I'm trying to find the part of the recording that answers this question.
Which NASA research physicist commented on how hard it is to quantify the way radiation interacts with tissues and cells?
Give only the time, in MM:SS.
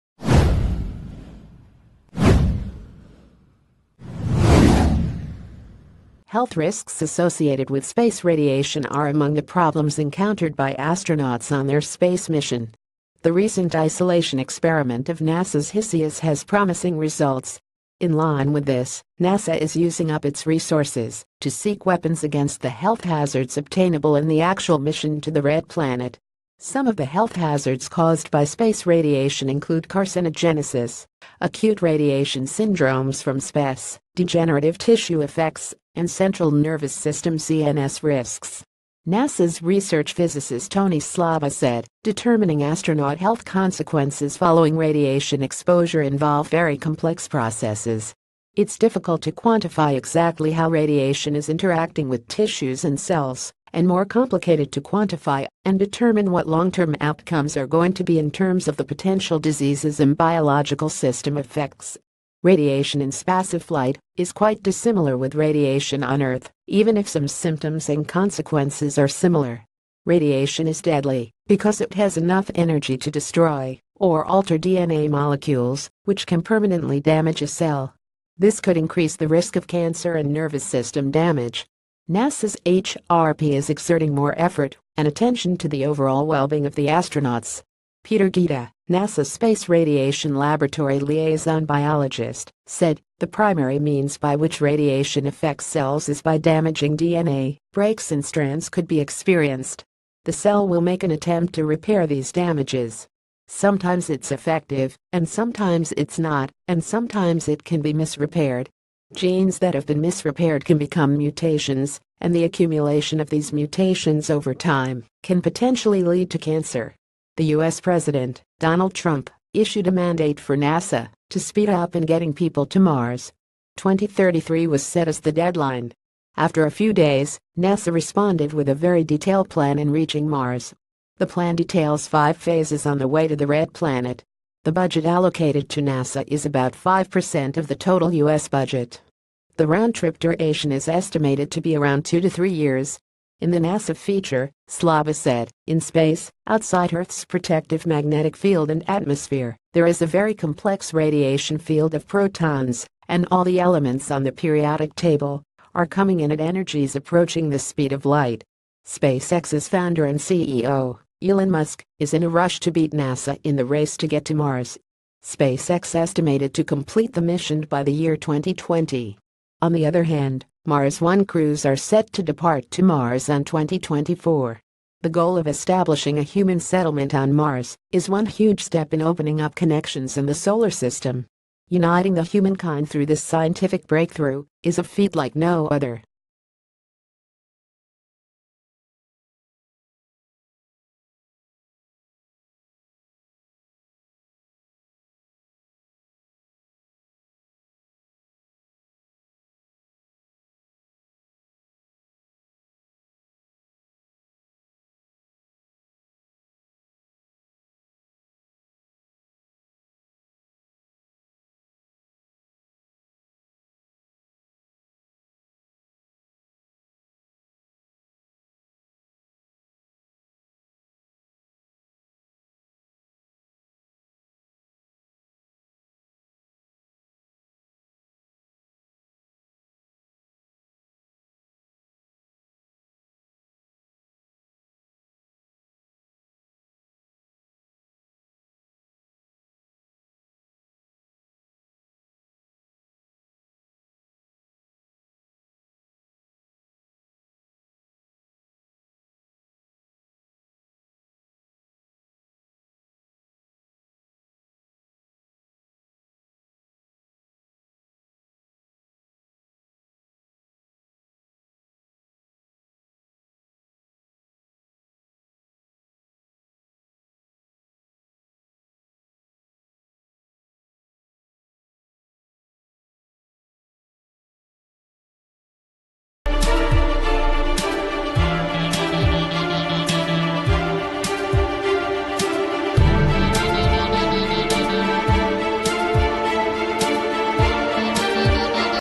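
00:40.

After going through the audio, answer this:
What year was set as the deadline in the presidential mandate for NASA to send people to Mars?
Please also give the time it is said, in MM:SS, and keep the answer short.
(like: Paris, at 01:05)
2033, at 02:03.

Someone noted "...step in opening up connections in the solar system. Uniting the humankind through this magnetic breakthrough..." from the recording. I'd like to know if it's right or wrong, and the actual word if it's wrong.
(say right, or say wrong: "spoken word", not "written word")
wrong: "scientific", not "magnetic".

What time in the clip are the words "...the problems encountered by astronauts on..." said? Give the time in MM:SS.
00:09.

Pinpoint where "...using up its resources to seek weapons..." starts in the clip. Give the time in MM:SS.
00:19.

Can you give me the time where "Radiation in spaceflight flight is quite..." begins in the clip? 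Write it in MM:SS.
01:02.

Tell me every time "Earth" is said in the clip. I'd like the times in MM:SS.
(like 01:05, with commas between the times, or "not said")
01:06, 02:26.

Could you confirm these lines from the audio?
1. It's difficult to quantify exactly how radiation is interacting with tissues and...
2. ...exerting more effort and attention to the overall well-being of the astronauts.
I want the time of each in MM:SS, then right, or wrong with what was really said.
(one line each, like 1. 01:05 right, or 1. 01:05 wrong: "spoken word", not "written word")
1. 00:48 right
2. 01:23 right.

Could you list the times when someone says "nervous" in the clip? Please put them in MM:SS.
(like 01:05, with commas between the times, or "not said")
00:36, 01:20.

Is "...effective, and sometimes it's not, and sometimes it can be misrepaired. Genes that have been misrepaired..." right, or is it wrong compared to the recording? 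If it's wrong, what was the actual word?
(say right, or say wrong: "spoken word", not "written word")
right.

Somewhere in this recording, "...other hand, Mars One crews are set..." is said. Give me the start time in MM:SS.
02:49.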